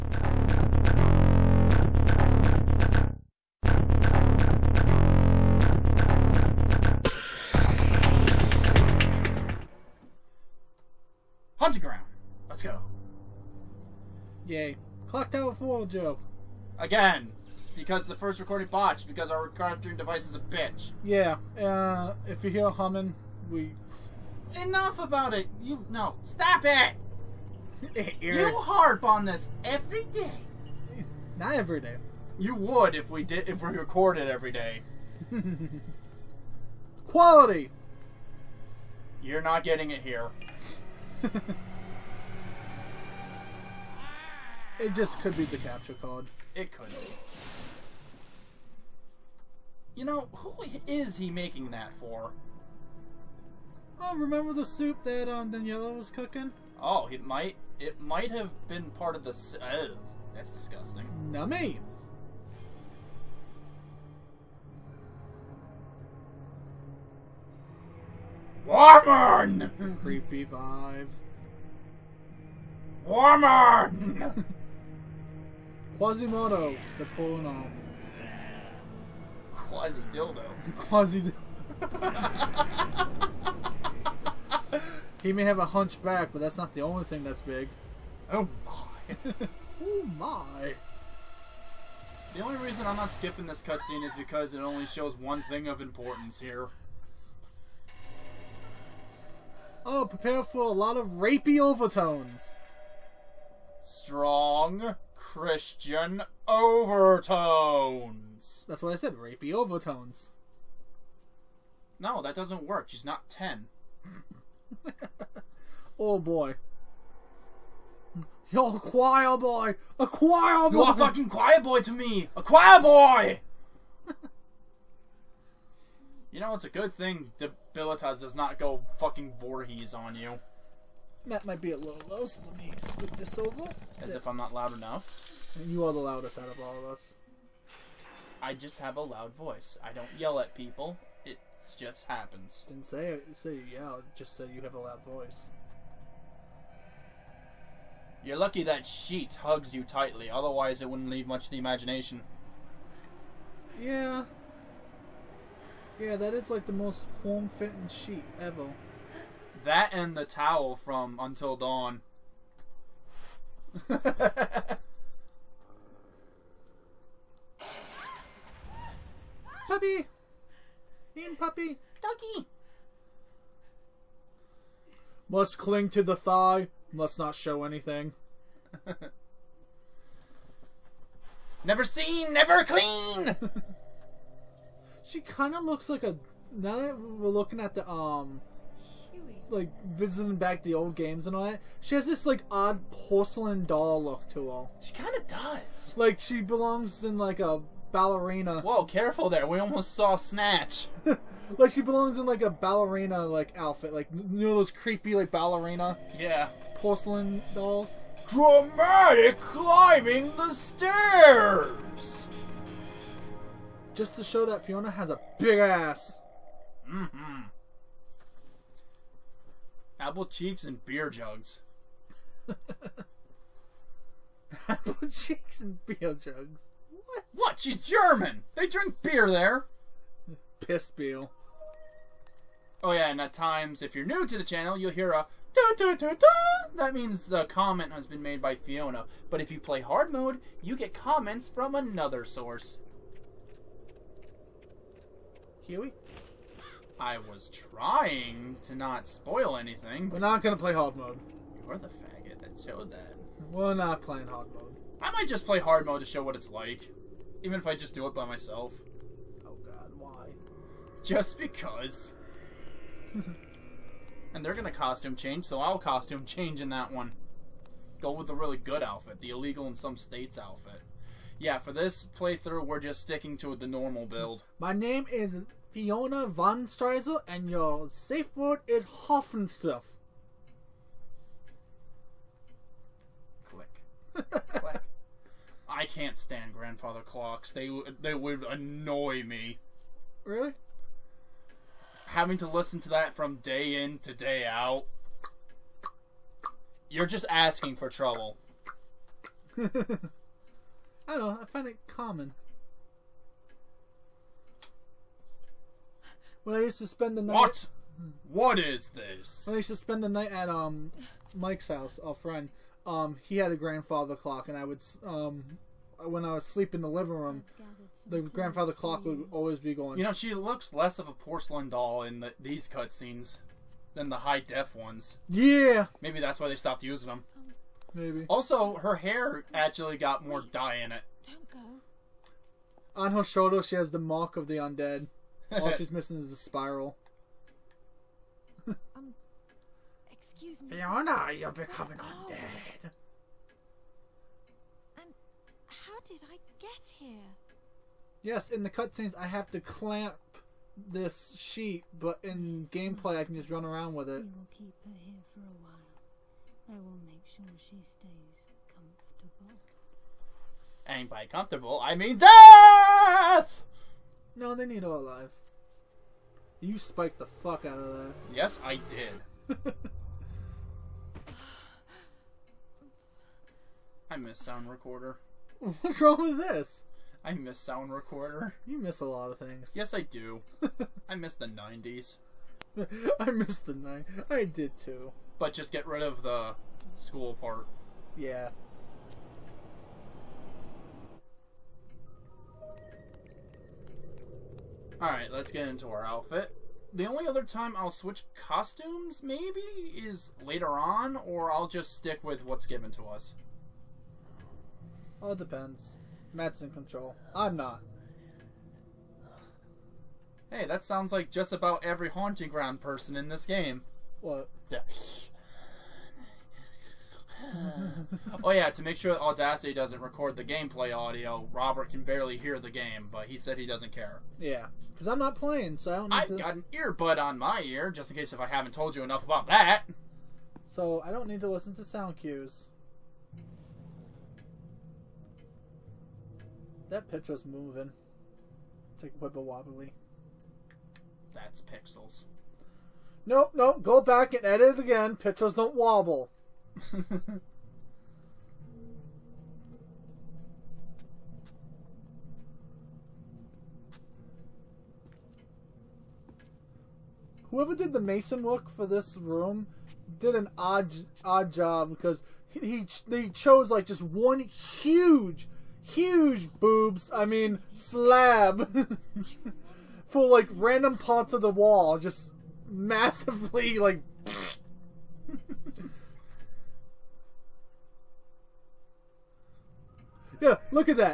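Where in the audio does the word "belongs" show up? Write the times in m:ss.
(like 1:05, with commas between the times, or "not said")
3:16, 3:21.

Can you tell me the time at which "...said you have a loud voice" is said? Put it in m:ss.
2:24.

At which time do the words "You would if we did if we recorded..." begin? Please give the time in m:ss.
0:32.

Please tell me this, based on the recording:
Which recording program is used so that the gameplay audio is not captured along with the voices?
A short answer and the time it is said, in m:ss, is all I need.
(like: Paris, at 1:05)
Audacity, at 6:59.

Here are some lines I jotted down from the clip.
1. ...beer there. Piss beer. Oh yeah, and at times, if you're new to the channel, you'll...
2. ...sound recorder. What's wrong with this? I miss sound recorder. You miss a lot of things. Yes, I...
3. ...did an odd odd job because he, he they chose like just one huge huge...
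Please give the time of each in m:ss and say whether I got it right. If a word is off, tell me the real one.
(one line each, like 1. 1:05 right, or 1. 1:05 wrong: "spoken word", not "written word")
1. 3:49 right
2. 6:14 right
3. 7:40 right.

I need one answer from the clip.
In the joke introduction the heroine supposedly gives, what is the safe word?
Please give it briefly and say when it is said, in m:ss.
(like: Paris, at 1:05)
Hoffenstuff, at 4:38.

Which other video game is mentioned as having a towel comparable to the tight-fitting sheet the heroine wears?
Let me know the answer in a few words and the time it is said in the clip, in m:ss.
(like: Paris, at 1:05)
Until Dawn, at 2:41.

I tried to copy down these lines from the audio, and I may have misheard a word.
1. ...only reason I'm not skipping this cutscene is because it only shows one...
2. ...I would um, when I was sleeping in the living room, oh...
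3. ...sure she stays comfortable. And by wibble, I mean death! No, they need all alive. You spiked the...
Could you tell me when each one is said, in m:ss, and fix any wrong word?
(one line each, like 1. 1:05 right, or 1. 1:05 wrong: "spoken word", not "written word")
1. 1:32 right
2. 5:14 right
3. 5:57 wrong: "comfortable", not "wibble".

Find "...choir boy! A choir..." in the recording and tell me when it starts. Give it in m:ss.
1:58.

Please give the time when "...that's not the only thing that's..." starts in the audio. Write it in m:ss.
1:26.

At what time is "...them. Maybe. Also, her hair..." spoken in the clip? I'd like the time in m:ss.
5:27.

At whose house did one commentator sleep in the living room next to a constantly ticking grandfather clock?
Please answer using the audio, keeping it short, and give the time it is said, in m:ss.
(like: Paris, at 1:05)
Mike's, at 5:11.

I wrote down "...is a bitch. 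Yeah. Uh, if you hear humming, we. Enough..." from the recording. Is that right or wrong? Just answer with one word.
right.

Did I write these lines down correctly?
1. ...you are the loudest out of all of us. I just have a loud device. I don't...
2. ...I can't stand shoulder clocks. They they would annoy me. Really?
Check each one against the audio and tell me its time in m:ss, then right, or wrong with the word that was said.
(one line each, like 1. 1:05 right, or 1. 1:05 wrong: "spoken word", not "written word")
1. 2:15 wrong: "voice", not "device"
2. 4:45 wrong: "grandfather", not "shoulder".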